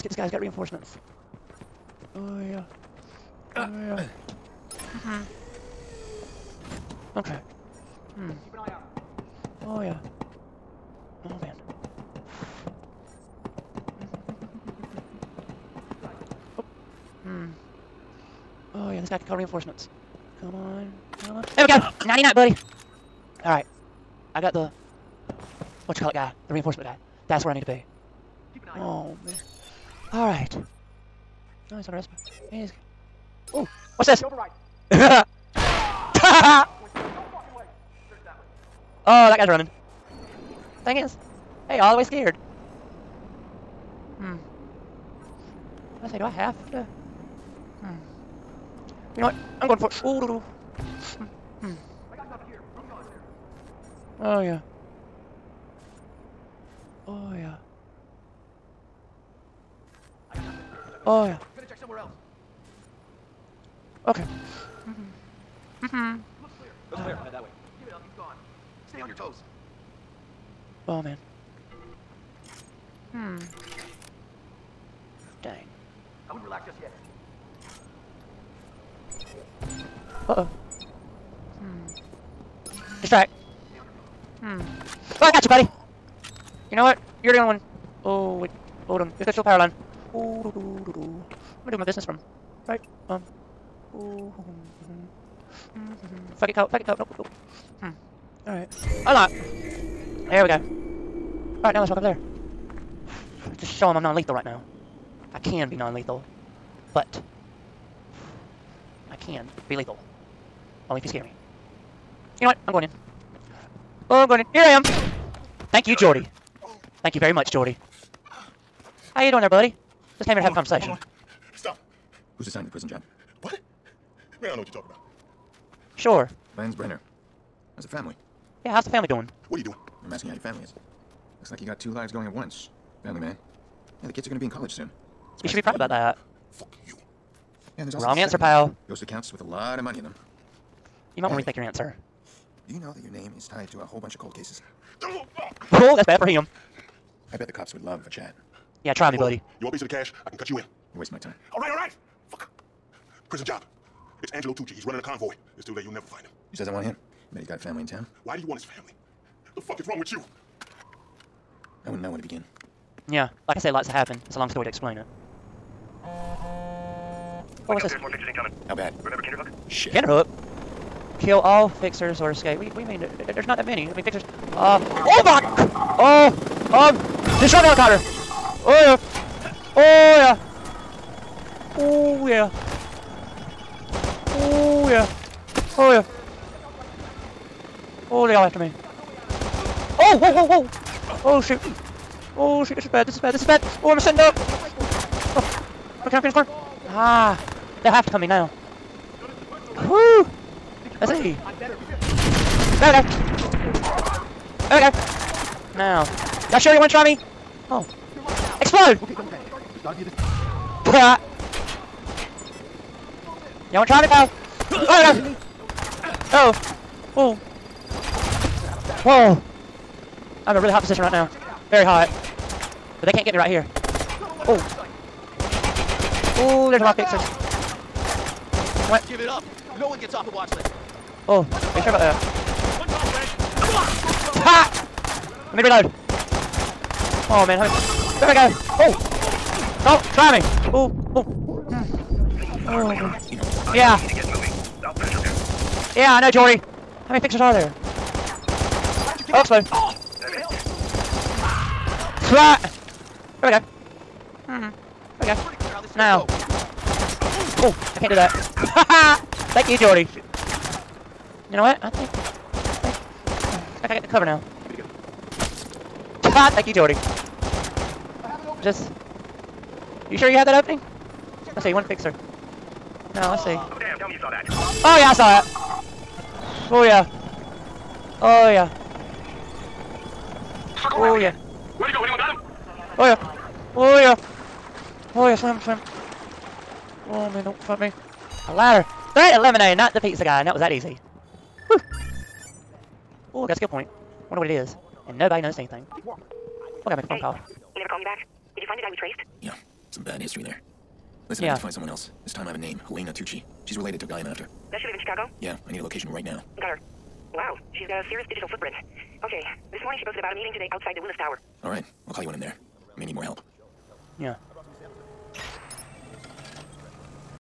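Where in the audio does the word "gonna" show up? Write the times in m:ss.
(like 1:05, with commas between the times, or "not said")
1:01, 1:31, 2:14.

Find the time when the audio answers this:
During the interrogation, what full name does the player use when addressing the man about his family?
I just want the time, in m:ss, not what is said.
2:06.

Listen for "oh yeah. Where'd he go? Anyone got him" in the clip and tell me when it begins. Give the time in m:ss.
4:40.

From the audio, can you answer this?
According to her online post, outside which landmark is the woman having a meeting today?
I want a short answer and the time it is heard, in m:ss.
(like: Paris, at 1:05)
Willis Tower, at 5:11.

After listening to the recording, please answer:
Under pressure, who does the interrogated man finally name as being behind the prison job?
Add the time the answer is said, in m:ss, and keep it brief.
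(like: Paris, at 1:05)
Angelo Tucci, at 2:34.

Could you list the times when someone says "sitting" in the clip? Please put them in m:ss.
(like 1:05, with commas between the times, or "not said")
3:13.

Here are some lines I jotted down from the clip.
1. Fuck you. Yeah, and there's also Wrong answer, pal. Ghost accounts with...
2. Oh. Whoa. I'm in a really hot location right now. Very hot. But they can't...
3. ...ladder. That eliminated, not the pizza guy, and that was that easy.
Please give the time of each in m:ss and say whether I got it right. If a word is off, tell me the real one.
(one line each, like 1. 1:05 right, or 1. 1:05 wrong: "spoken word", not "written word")
1. 2:16 right
2. 3:37 wrong: "position", not "location"
3. 4:48 right.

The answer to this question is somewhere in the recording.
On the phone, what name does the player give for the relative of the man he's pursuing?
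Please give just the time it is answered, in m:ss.
5:02.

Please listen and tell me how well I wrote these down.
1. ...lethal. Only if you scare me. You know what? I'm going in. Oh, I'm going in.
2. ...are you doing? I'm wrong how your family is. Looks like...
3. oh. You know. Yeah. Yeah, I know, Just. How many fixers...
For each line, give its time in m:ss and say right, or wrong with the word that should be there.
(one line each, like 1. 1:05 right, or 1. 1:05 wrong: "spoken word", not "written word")
1. 1:49 right
2. 2:09 wrong: "asking", not "wrong"
3. 4:01 wrong: "Jordi", not "Just".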